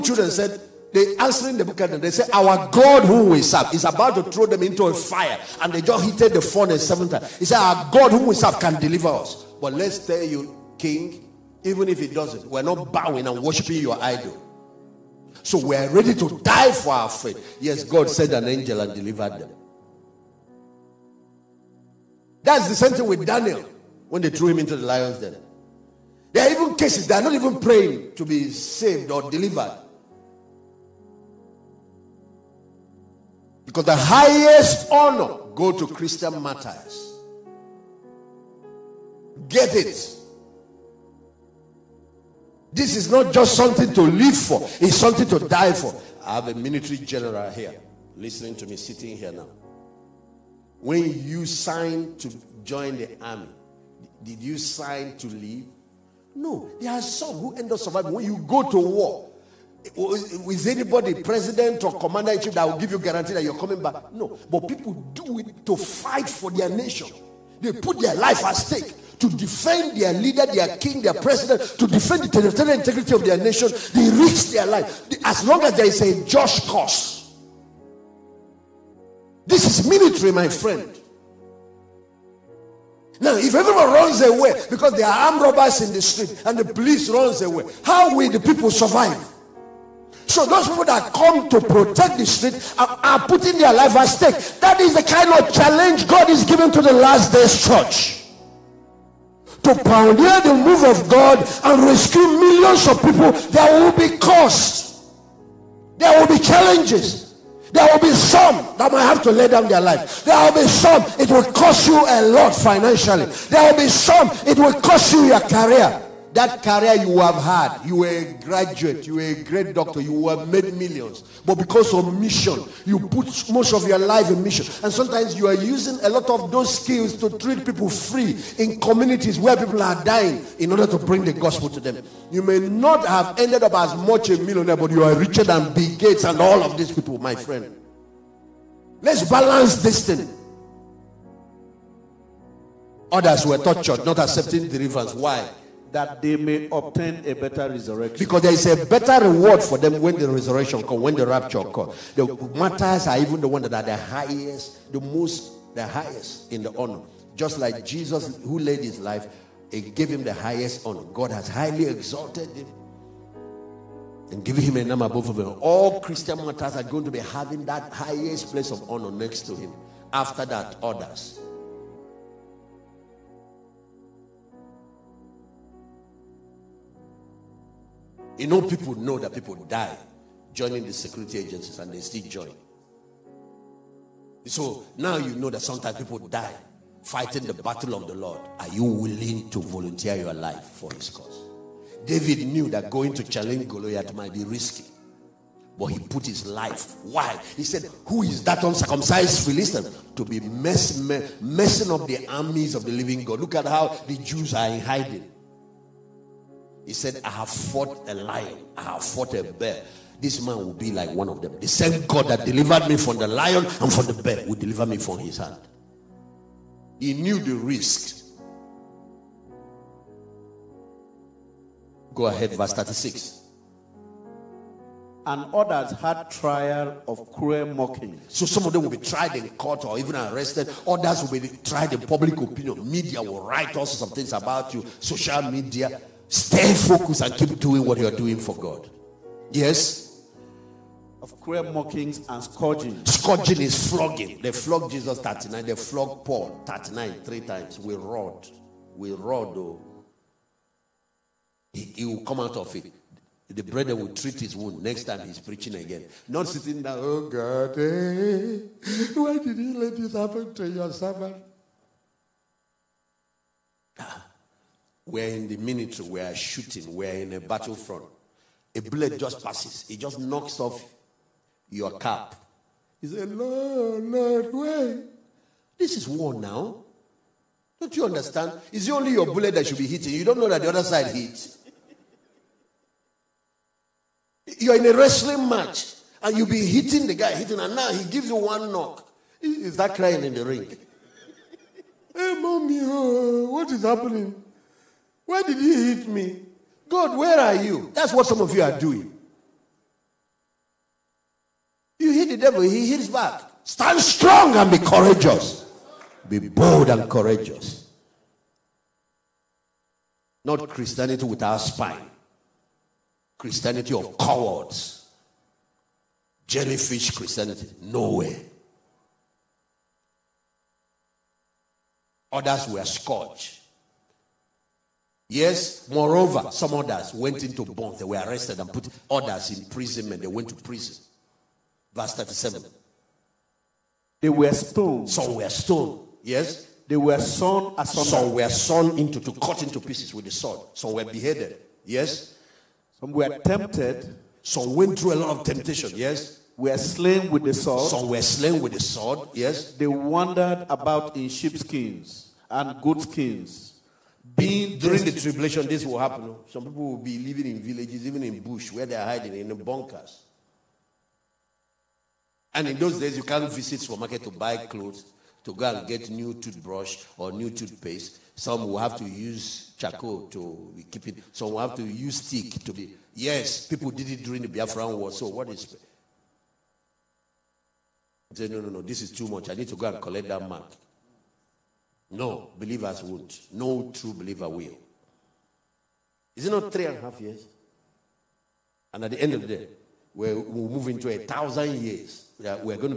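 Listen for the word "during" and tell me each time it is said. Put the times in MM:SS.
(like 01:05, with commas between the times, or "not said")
05:54, 06:14.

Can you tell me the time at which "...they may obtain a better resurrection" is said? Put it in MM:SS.
02:26.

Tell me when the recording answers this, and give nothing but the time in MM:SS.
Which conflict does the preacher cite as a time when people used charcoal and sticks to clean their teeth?
06:14.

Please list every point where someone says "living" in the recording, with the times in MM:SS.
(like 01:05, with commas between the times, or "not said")
03:22, 05:57.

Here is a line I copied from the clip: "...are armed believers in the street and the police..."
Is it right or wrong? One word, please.
wrong.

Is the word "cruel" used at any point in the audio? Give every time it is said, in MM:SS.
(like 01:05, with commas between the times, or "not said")
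03:47, 04:01.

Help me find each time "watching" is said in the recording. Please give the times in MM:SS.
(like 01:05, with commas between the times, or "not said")
not said.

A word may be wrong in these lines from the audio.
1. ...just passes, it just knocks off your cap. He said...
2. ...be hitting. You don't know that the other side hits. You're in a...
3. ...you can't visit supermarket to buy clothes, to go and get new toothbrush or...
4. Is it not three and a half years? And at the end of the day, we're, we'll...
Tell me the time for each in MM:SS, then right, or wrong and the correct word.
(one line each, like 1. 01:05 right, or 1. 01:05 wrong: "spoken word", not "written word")
1. 04:29 right
2. 04:39 right
3. 06:03 right
4. 06:26 right.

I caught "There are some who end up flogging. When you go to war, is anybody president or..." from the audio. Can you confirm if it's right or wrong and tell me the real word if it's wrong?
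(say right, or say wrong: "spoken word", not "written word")
wrong: "surviving", not "flogging".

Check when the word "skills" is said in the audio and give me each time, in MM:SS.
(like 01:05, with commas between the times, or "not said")
02:06.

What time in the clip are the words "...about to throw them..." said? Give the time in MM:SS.
00:03.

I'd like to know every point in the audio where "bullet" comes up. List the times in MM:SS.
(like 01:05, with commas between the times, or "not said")
04:28, 04:39.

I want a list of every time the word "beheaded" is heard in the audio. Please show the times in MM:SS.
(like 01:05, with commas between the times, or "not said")
05:41.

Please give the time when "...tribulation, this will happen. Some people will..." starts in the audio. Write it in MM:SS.
05:55.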